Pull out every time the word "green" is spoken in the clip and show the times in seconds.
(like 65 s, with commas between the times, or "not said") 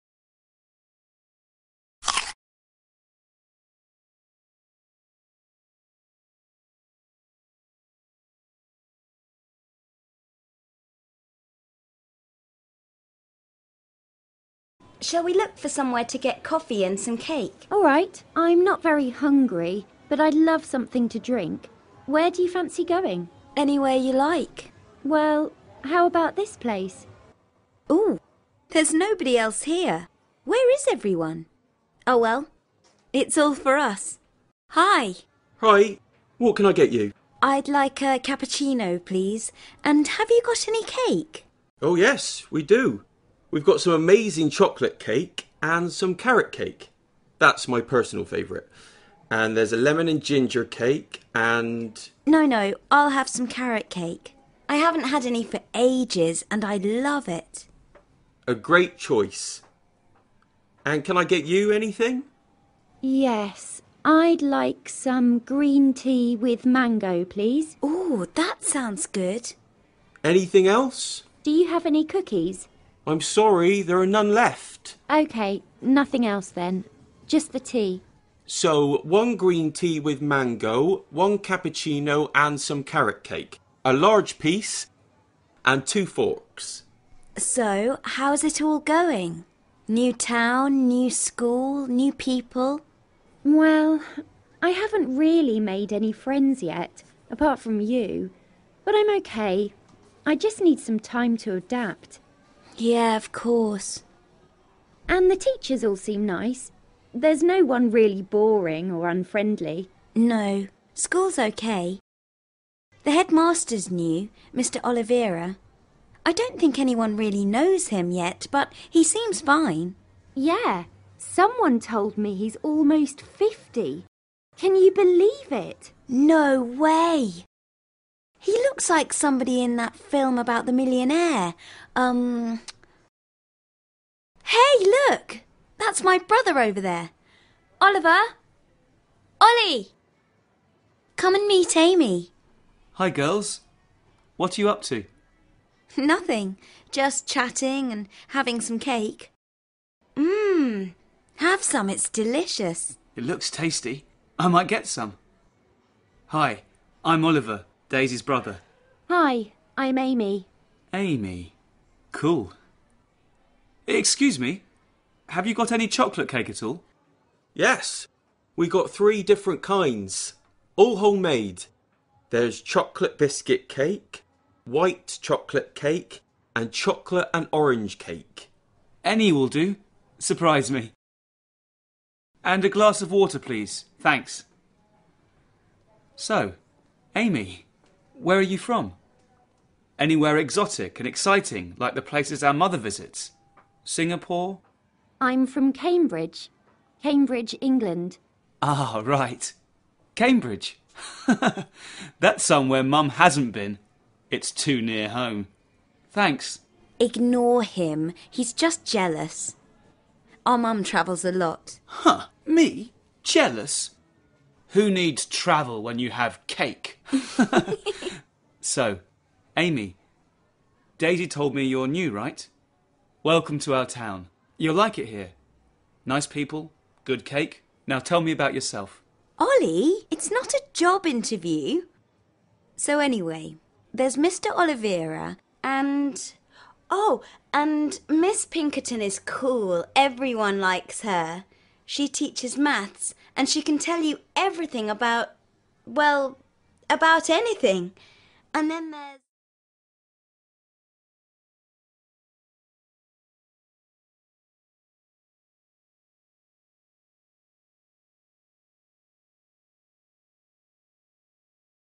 65 s, 79 s.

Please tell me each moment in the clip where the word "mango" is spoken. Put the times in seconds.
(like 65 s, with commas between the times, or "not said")
66 s, 80 s.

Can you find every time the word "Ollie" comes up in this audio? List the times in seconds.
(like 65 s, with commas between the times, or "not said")
139 s, 229 s.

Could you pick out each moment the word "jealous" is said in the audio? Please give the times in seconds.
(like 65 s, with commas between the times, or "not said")
208 s, 213 s.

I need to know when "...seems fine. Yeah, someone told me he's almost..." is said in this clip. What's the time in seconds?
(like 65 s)
119 s.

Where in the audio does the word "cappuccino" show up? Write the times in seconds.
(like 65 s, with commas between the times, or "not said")
38 s, 81 s.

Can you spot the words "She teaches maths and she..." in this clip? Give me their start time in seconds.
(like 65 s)
241 s.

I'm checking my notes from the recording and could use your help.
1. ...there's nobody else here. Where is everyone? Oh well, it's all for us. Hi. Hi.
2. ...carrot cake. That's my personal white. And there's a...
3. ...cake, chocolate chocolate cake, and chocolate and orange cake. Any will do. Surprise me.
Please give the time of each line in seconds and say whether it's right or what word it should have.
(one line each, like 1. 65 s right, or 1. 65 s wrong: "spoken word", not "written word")
1. 28 s right
2. 46 s wrong: "favourite", not "white"
3. 173 s wrong: "white", not "chocolate".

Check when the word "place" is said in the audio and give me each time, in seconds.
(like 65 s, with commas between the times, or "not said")
26 s, 192 s.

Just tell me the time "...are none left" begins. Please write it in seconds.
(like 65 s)
73 s.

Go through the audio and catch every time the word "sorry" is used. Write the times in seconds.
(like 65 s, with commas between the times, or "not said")
73 s.